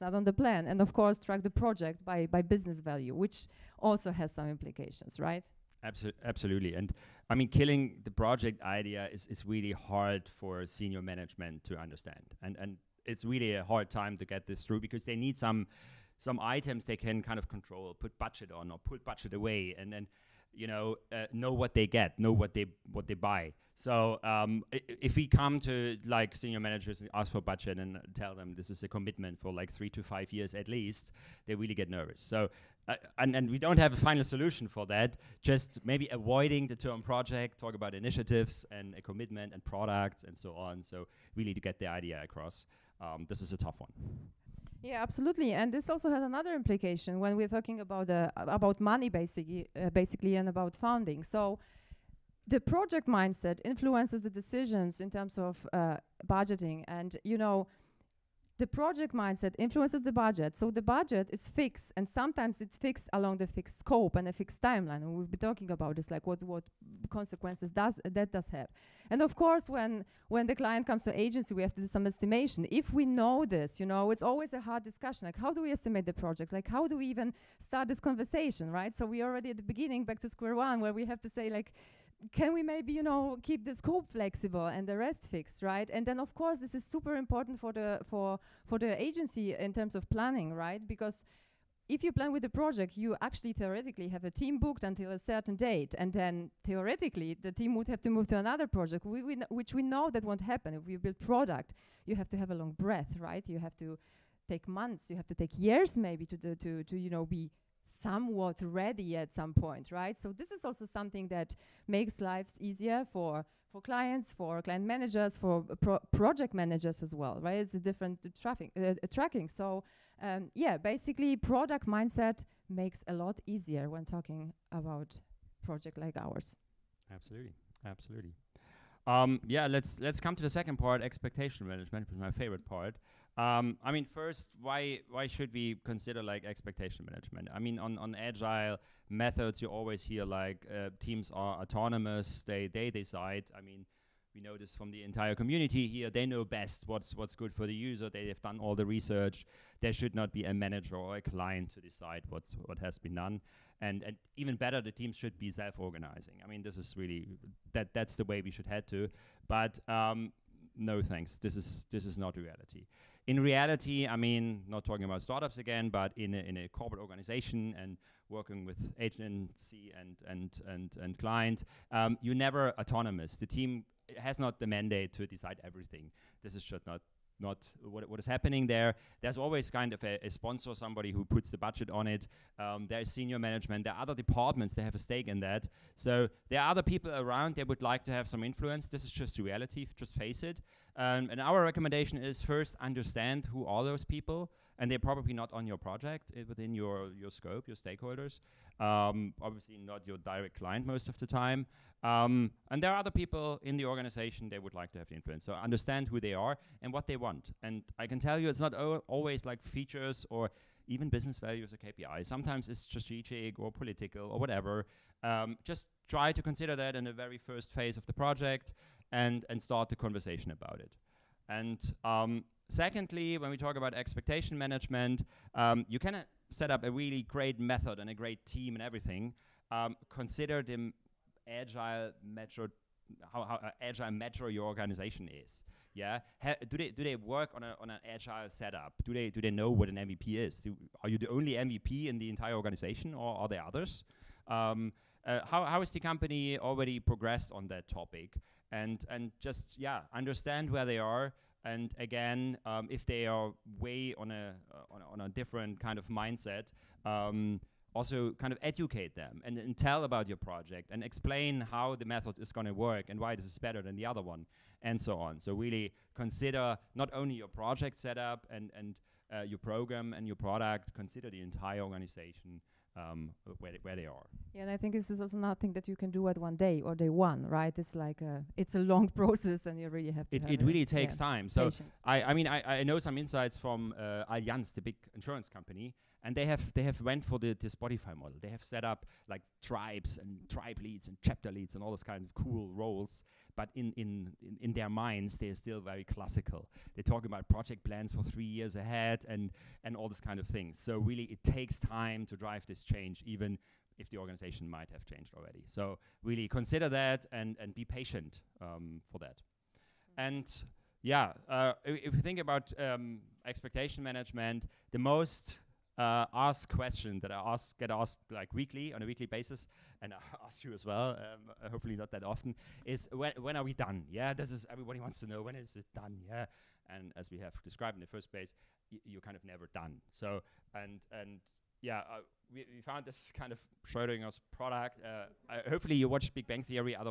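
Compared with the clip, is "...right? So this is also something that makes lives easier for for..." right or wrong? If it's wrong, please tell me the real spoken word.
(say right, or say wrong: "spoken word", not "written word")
right.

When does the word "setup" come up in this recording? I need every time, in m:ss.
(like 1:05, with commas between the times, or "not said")
3:58, 4:27.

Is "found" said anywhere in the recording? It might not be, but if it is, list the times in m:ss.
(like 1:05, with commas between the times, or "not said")
5:32.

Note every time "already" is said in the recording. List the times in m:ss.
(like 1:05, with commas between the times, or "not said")
1:19, 4:06, 5:05.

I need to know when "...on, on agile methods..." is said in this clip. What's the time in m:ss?
2:17.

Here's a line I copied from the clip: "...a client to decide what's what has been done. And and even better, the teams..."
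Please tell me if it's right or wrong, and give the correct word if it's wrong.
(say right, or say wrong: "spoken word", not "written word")
right.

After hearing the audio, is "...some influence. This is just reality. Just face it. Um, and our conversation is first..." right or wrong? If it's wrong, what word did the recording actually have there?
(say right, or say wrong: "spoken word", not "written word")
wrong: "recommendation", not "conversation".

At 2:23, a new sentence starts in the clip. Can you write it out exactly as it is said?
I mean, we know this from the entire community here.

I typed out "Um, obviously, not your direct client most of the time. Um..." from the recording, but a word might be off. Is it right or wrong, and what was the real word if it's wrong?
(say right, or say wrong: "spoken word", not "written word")
right.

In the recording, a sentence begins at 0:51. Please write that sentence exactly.
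So the project mindset influences the decisions in terms of uh, budgeting, and you know the project mindset influences the budget.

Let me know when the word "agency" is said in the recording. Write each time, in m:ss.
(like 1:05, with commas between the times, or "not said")
1:11, 1:29, 2:48.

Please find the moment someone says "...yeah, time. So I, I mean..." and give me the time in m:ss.
4:41.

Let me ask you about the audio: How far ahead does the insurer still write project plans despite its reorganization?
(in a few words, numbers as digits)
3 years.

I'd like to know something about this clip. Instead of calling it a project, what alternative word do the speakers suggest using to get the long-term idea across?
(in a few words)
initiatives.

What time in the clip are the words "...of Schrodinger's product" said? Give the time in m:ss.
5:33.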